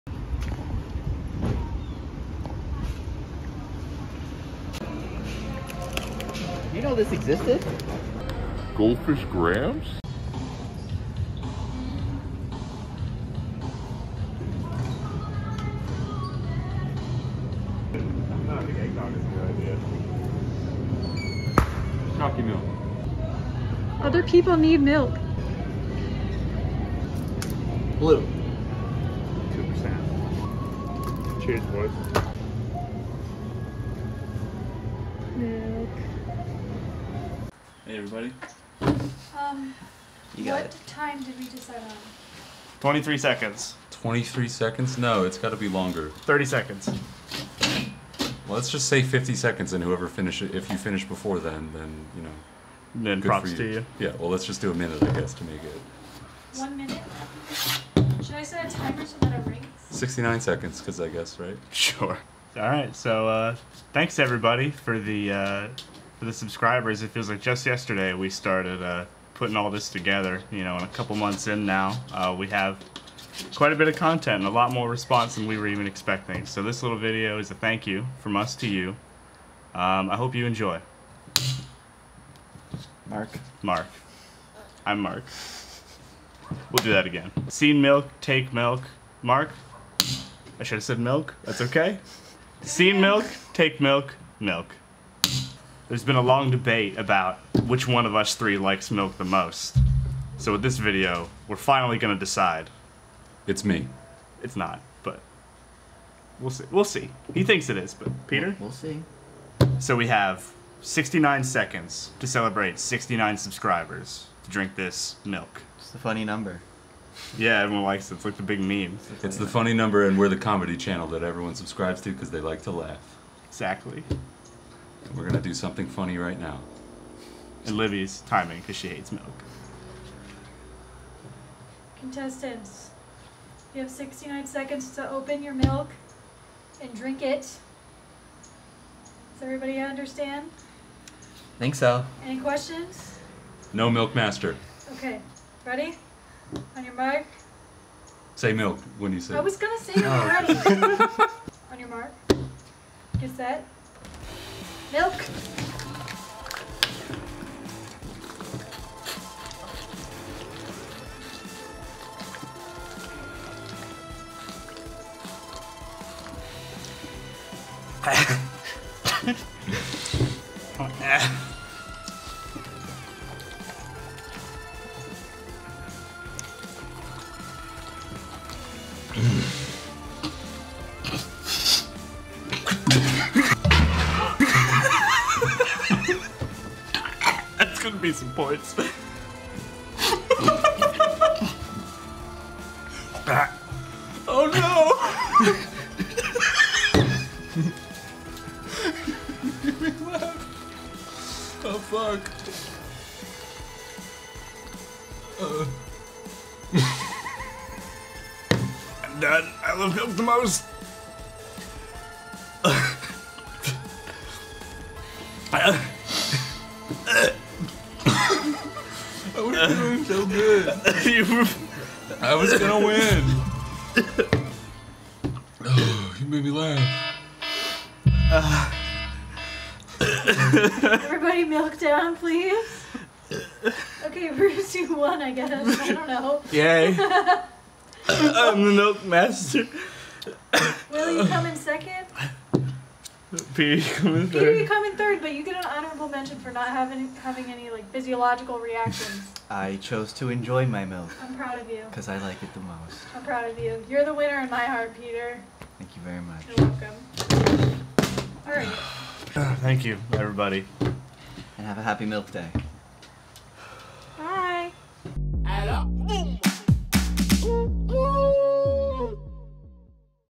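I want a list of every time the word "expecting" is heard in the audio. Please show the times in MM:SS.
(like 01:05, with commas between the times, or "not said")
01:15.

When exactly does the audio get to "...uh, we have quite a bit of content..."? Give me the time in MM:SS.
01:12.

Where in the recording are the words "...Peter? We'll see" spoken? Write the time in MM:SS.
01:48.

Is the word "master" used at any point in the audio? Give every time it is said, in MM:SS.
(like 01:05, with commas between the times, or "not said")
02:24, 03:59.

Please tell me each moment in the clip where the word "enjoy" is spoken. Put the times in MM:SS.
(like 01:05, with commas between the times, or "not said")
01:20, 04:10.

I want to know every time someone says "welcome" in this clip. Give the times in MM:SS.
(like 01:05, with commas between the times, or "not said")
04:17.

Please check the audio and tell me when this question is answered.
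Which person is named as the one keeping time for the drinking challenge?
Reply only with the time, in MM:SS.
02:07.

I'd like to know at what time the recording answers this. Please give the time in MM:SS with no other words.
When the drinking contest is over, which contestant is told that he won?
03:54.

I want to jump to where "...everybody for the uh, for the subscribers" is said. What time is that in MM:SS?
01:04.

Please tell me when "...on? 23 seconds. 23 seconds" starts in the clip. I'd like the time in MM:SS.
00:41.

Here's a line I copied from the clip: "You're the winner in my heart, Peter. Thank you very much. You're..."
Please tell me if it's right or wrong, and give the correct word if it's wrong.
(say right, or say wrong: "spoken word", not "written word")
right.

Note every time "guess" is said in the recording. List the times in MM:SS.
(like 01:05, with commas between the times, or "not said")
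00:55, 01:01, 03:55.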